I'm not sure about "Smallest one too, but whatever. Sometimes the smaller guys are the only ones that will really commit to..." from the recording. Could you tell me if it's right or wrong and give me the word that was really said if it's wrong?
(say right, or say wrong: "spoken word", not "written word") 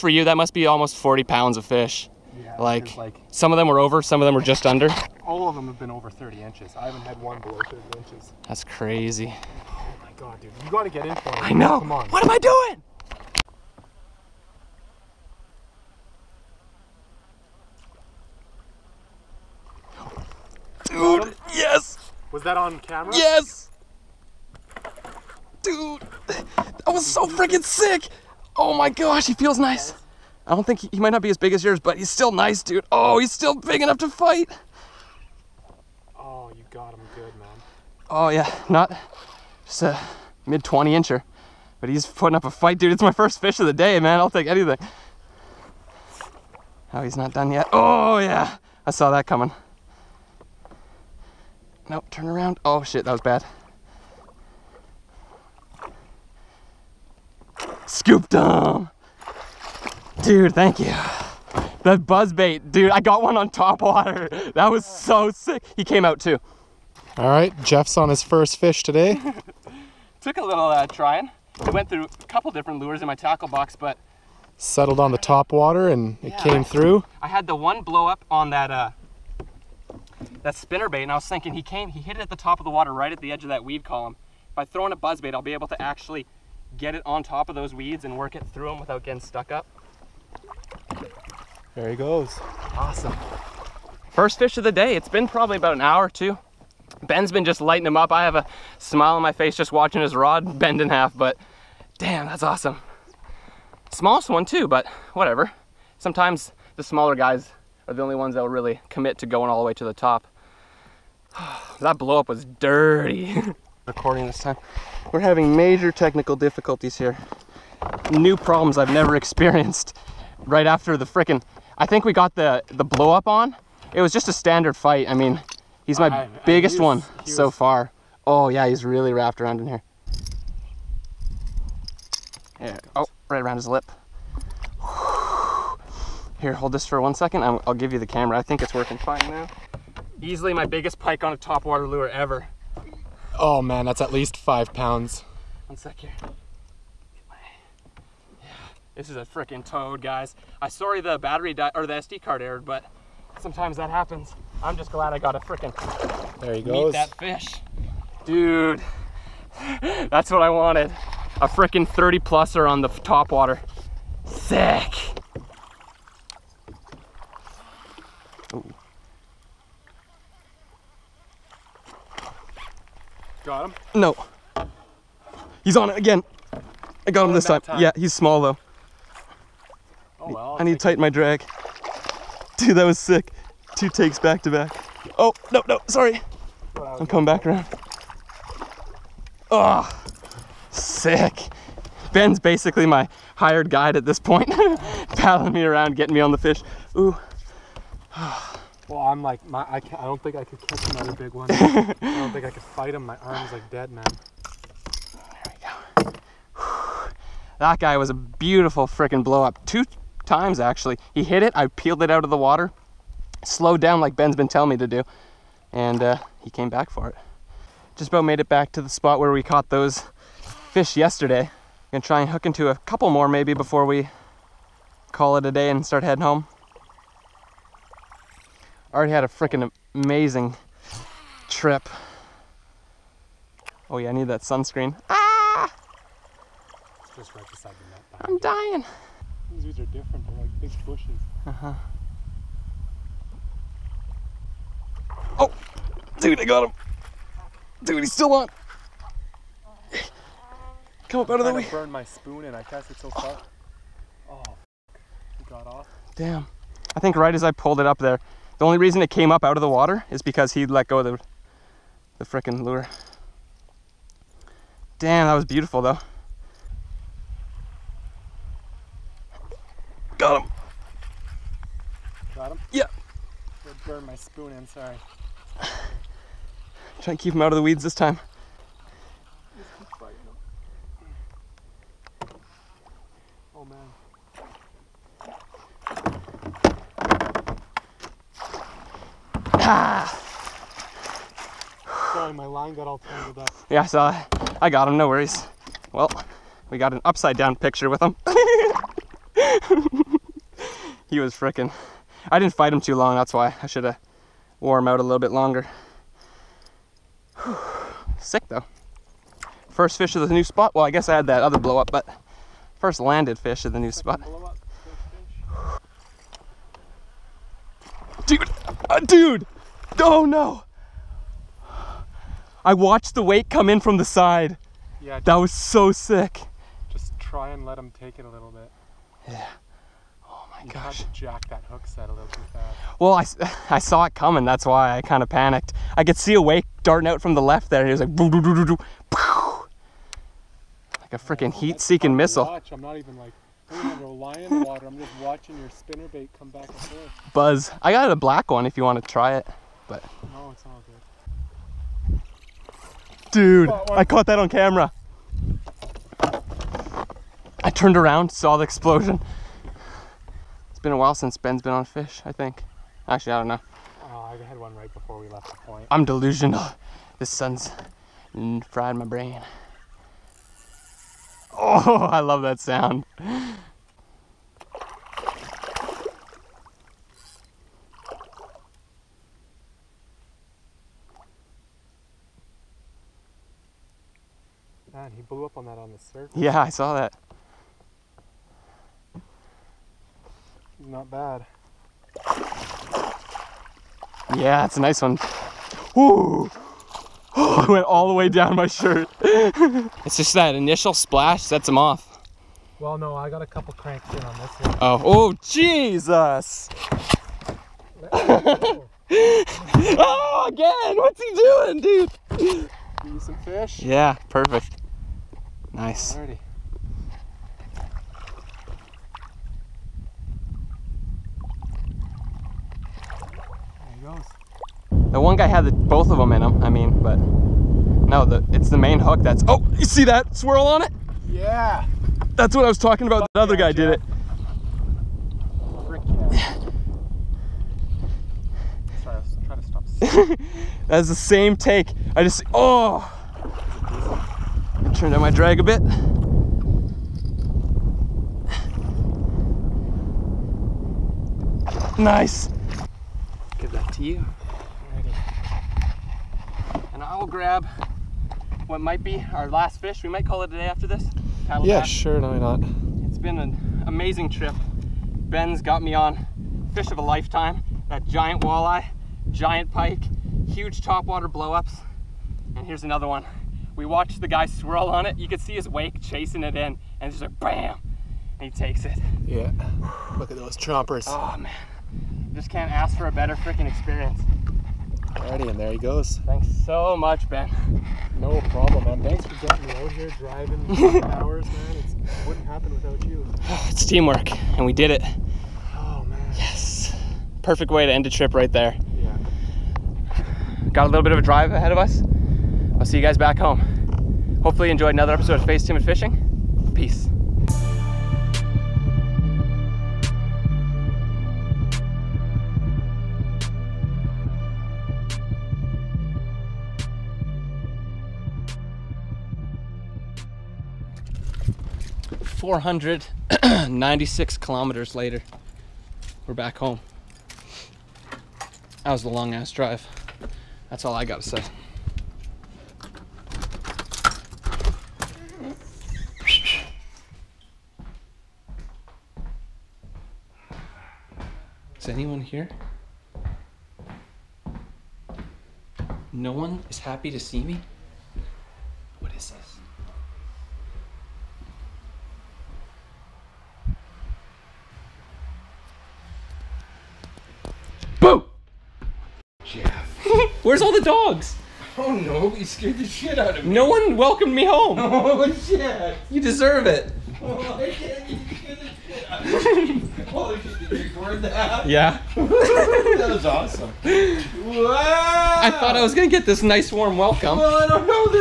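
right.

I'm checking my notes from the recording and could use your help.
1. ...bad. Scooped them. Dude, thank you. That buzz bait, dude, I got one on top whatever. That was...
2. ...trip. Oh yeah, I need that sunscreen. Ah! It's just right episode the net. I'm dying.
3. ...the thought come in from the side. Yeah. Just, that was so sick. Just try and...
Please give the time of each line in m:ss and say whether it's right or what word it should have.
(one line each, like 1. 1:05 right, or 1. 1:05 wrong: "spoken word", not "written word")
1. 0:53 wrong: "water", not "whatever"
2. 3:51 wrong: "beside", not "episode"
3. 5:23 wrong: "weight", not "thought".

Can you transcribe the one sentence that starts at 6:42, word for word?
Well, no, I got a couple cranks in on this one.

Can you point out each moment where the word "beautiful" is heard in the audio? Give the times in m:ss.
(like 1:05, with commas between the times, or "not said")
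3:28, 4:25.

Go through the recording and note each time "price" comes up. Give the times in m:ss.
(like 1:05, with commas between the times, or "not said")
not said.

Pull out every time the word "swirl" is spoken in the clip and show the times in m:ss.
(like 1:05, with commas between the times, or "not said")
7:10, 7:54.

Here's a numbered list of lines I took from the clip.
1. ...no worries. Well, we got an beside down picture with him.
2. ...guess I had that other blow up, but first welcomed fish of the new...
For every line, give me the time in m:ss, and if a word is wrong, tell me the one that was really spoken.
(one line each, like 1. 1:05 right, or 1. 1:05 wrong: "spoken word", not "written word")
1. 4:54 wrong: "upside", not "beside"
2. 5:10 wrong: "landed", not "welcomed".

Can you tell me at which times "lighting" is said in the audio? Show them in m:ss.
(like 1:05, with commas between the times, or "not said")
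1:37.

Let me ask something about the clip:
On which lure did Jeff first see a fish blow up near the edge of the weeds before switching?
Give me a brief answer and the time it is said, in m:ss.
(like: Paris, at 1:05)
spinner bait, at 1:20.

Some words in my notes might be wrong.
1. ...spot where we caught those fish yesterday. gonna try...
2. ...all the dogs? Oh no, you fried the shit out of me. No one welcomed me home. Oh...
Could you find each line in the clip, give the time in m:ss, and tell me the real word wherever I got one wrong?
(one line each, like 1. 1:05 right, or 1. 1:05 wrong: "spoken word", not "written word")
1. 3:38 right
2. 9:20 wrong: "scared", not "fried".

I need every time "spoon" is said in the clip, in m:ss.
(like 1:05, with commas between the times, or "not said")
4:12, 4:34.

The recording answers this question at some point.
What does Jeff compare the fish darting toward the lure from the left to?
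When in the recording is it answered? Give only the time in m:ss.
5:41.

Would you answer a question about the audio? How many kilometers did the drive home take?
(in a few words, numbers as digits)
496.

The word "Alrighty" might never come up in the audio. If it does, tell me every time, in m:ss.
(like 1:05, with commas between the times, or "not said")
6:56, 8:05.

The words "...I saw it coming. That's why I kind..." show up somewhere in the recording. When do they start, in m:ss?
5:33.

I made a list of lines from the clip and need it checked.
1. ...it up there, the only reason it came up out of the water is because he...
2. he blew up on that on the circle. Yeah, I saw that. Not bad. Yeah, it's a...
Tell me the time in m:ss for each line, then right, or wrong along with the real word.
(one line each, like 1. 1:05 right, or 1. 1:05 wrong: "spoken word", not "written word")
1. 4:17 right
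2. 6:25 right.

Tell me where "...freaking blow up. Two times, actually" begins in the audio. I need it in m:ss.
3:28.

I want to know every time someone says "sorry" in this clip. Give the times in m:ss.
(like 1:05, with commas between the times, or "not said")
2:30, 3:05, 4:34, 4:49, 7:19.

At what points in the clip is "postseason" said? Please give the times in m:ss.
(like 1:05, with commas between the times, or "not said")
not said.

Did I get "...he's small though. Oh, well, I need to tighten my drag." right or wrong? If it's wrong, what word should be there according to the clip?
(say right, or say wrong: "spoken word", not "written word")
right.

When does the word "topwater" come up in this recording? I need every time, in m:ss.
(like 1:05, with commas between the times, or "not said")
2:21, 7:50.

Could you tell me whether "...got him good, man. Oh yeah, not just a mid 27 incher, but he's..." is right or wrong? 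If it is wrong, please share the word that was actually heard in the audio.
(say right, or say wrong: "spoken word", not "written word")
wrong: "20", not "27".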